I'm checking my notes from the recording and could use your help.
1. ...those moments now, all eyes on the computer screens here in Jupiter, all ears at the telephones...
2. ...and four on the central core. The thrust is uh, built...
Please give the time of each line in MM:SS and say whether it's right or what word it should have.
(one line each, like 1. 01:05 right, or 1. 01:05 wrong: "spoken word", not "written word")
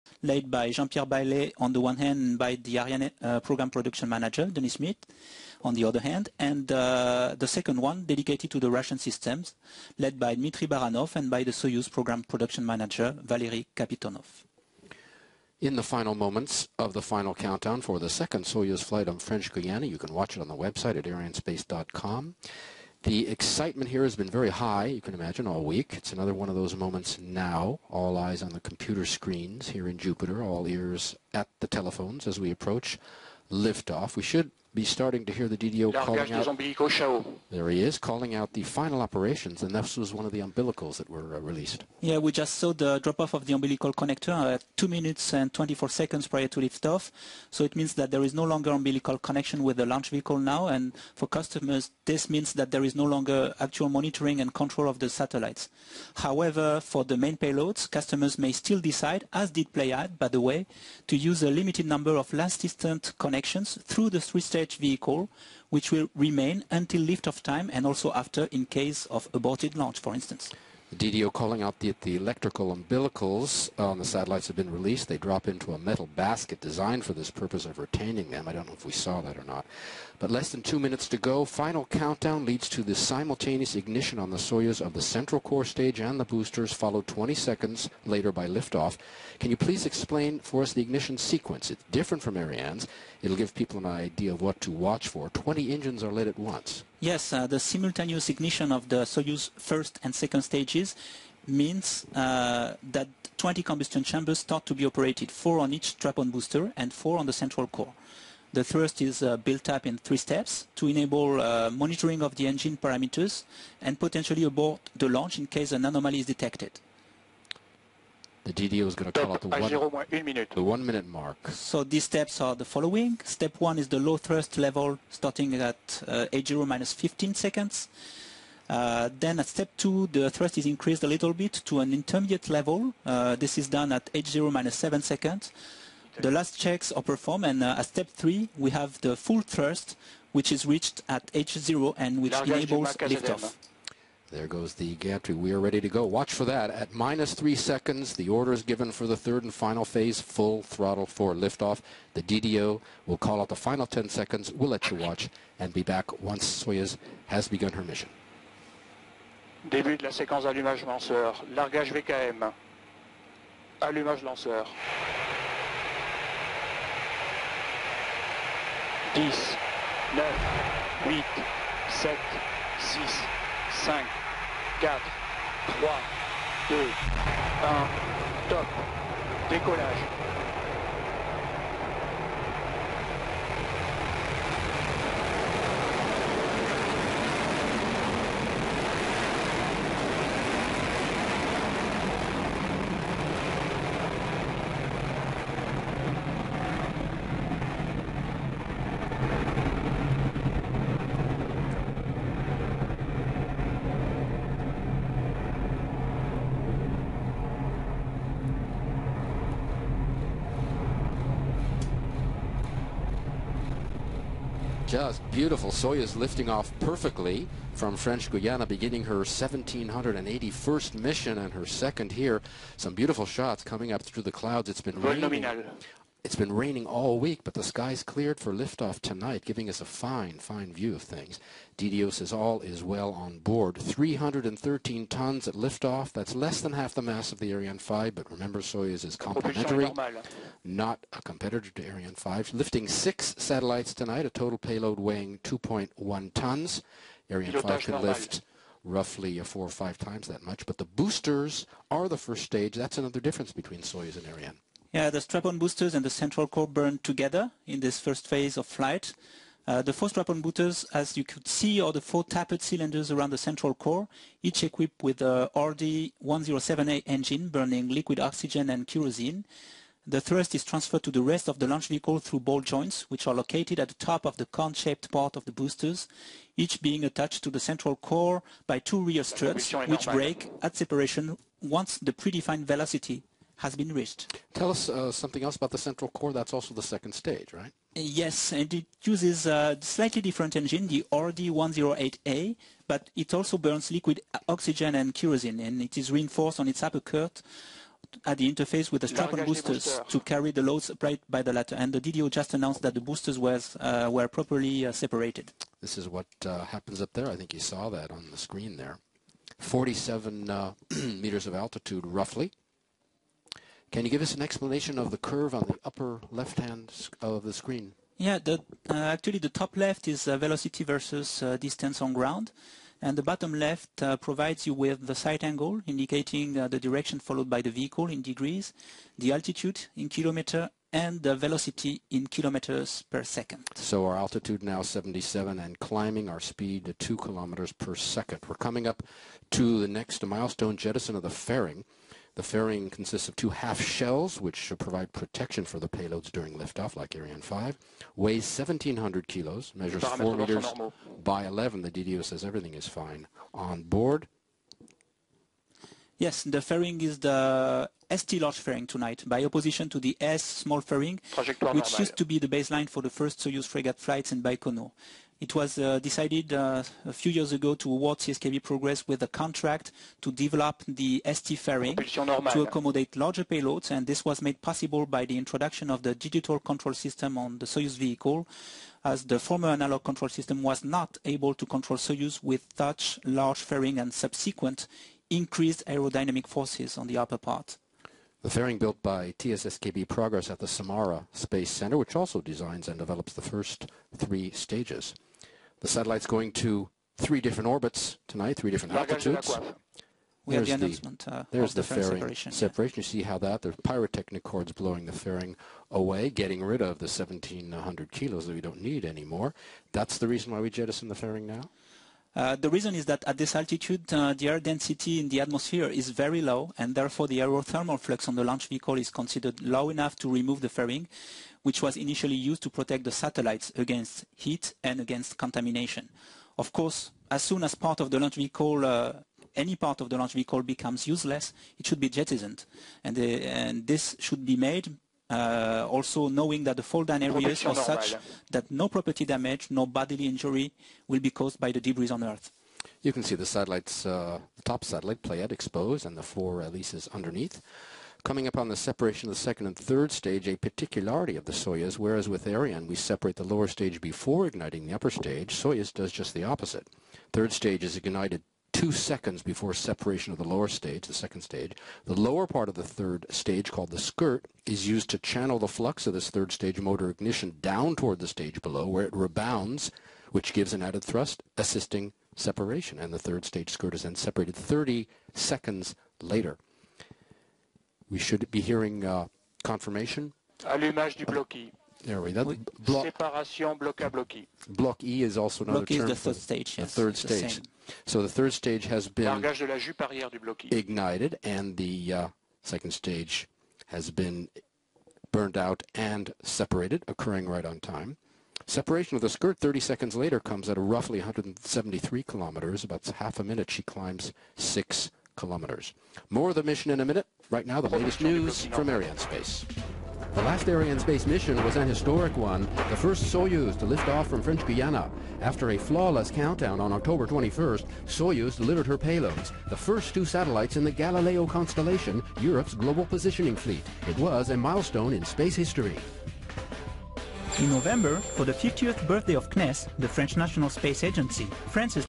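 1. 00:26 right
2. 01:46 right.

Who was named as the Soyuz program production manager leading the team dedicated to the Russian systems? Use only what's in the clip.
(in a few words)
Valery Kapitonov.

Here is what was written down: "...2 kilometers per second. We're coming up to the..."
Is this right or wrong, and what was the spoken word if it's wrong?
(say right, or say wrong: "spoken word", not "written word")
right.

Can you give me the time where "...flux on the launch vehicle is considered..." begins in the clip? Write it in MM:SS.
06:57.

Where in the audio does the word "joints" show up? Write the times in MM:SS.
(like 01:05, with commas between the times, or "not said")
04:32.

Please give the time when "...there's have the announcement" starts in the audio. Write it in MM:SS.
06:40.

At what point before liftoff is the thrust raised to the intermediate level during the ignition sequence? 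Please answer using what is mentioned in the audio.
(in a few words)
H0 minus 7 seconds.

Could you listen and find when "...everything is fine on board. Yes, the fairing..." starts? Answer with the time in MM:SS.
05:52.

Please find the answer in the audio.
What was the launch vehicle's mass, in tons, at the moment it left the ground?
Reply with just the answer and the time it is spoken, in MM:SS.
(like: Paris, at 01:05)
313 tons, at 03:53.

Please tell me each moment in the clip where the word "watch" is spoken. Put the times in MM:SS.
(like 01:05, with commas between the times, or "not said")
00:20, 01:34, 02:26, 02:34.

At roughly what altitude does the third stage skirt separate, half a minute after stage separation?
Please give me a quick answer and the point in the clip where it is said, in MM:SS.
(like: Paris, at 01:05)
173 kilometers, at 08:21.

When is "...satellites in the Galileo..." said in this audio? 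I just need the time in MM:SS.
08:40.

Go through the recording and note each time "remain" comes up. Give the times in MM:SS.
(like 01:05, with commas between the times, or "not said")
01:06.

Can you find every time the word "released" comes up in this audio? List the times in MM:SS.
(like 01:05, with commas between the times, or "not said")
00:41, 01:14.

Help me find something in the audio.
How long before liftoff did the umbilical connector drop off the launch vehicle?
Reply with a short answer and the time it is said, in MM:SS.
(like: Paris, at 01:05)
2 minutes and 24 seconds, at 00:44.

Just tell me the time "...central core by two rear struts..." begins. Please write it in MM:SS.
04:37.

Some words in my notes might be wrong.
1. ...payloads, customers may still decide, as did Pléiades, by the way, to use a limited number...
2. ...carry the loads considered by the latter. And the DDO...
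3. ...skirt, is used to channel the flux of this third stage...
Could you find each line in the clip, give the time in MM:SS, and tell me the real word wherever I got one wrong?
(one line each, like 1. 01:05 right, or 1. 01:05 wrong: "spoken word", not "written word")
1. 00:57 right
2. 05:00 wrong: "applied", not "considered"
3. 07:43 right.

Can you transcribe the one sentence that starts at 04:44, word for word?
Tell us uh, something else about the central core.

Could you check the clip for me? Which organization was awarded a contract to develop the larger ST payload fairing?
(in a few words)
CSKB Progress.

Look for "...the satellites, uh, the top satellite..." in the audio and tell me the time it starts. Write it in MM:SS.
07:23.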